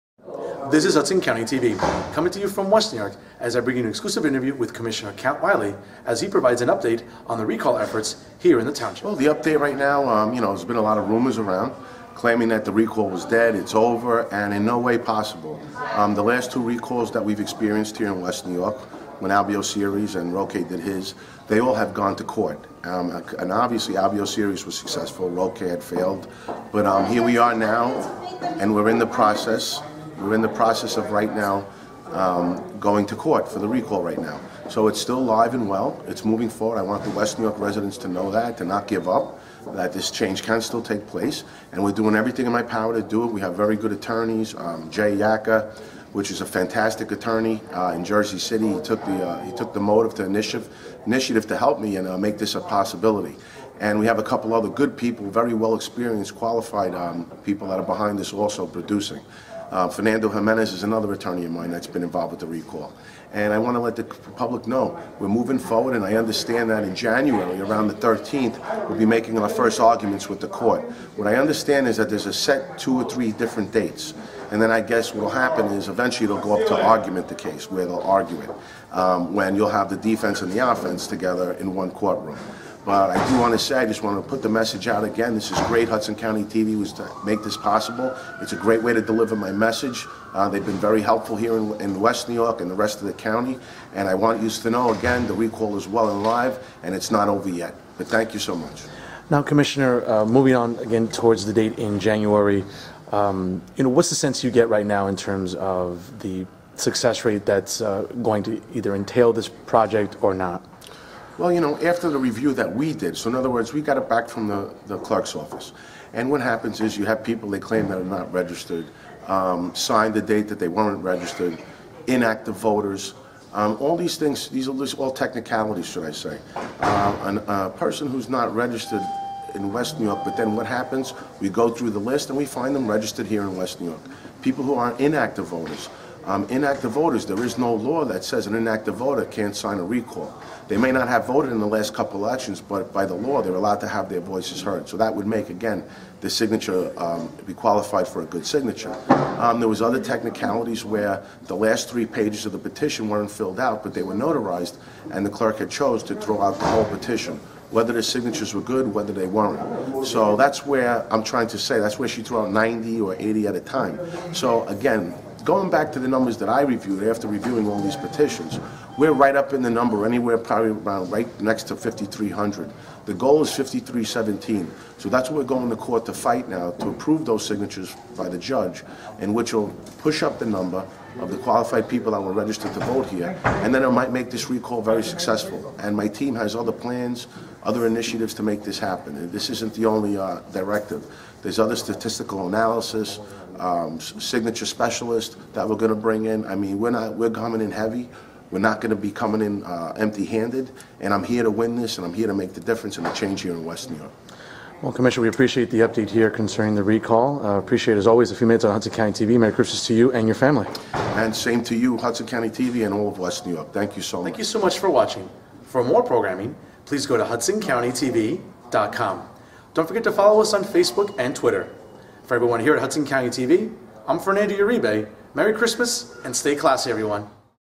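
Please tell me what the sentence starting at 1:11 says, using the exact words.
What I understand is that there's a set two or three different dates.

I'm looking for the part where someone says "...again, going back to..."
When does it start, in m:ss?
2:44.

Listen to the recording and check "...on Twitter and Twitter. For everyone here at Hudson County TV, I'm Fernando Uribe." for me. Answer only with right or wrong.
wrong.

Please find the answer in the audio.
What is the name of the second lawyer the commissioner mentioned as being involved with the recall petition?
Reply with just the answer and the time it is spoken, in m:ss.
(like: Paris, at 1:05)
Fernando Jimenez, at 0:59.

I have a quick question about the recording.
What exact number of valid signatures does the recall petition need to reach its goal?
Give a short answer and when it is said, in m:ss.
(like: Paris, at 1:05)
5,317, at 2:53.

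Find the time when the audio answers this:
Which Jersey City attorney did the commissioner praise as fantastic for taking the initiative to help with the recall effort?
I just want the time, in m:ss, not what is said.
0:44.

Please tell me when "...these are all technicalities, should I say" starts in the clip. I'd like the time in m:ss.
2:04.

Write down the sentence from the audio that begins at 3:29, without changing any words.
Merry Christmas to you and your family.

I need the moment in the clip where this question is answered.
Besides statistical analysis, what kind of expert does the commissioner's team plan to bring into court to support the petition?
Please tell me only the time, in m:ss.
3:13.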